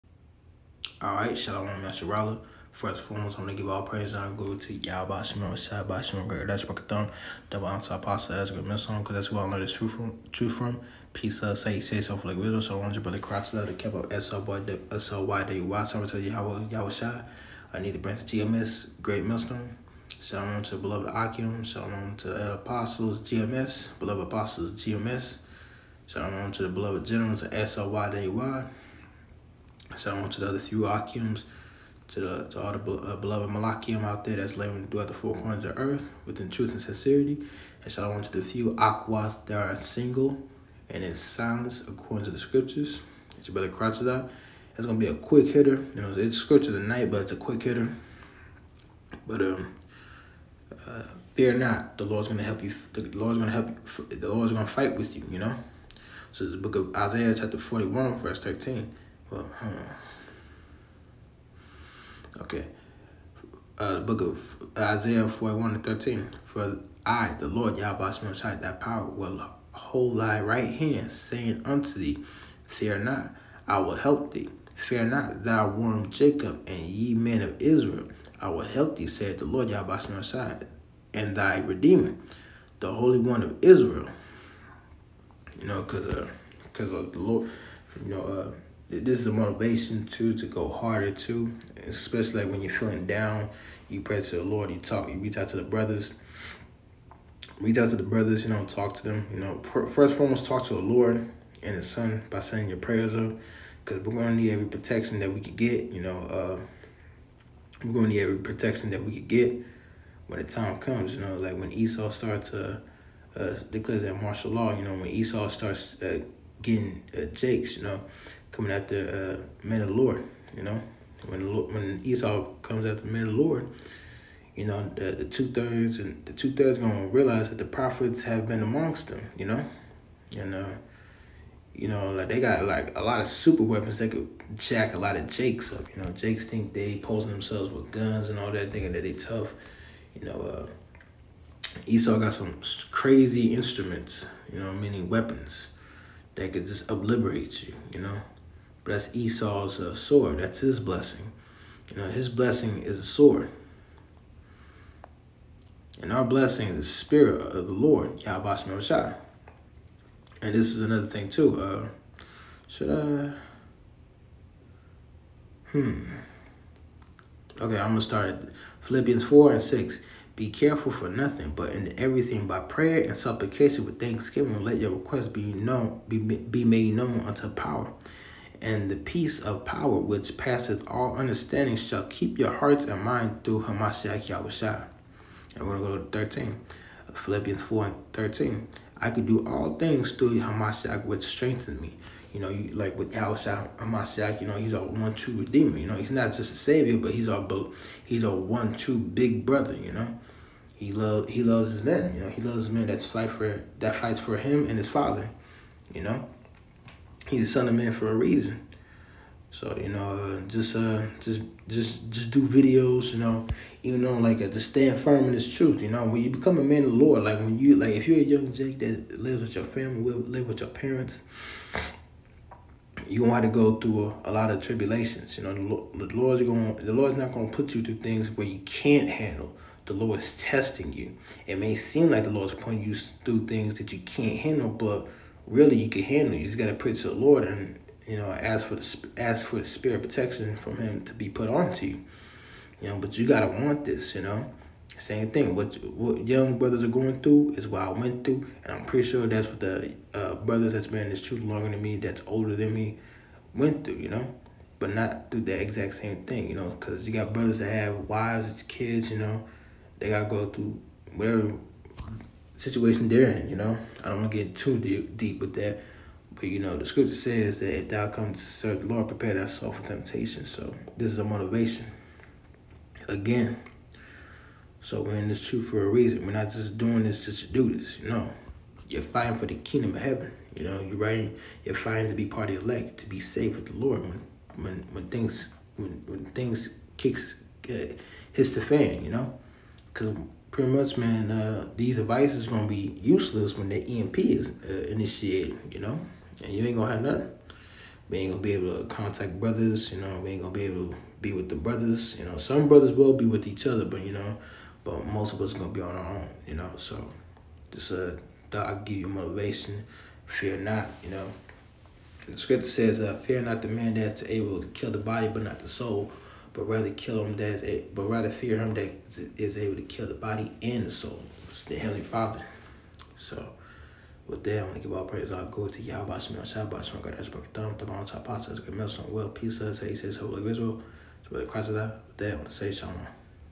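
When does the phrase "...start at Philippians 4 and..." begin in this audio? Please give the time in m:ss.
2:48.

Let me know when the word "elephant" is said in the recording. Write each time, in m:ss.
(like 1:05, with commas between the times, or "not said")
not said.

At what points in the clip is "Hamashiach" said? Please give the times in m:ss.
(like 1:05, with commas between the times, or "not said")
3:03, 3:10.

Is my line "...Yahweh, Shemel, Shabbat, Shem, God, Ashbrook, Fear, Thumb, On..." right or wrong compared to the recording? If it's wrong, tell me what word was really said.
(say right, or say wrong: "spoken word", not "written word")
wrong: "Thumb", not "Fear".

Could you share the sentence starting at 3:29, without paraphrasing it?
So you know, uh, just uh, just just just do videos.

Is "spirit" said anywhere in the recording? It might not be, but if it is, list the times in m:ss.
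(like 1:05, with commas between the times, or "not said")
2:36, 3:59.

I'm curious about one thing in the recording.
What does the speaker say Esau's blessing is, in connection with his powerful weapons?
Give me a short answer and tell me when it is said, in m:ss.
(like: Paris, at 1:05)
a sword, at 2:32.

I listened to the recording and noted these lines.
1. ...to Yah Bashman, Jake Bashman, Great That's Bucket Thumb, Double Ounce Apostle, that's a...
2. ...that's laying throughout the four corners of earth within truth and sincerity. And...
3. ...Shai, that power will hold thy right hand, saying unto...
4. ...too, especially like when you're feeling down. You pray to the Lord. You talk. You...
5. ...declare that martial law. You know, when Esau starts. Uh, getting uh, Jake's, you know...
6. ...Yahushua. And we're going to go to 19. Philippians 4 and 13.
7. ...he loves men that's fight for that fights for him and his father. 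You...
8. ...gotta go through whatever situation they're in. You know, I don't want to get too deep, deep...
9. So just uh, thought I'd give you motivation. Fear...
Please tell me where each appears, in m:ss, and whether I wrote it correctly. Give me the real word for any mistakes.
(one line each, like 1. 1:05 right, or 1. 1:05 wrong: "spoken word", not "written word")
1. 0:04 wrong: "Shad", not "Jake"
2. 0:34 right
3. 1:08 right
4. 1:31 right
5. 1:53 right
6. 3:04 wrong: "13", not "19"
7. 3:22 right
8. 4:20 right
9. 5:06 right.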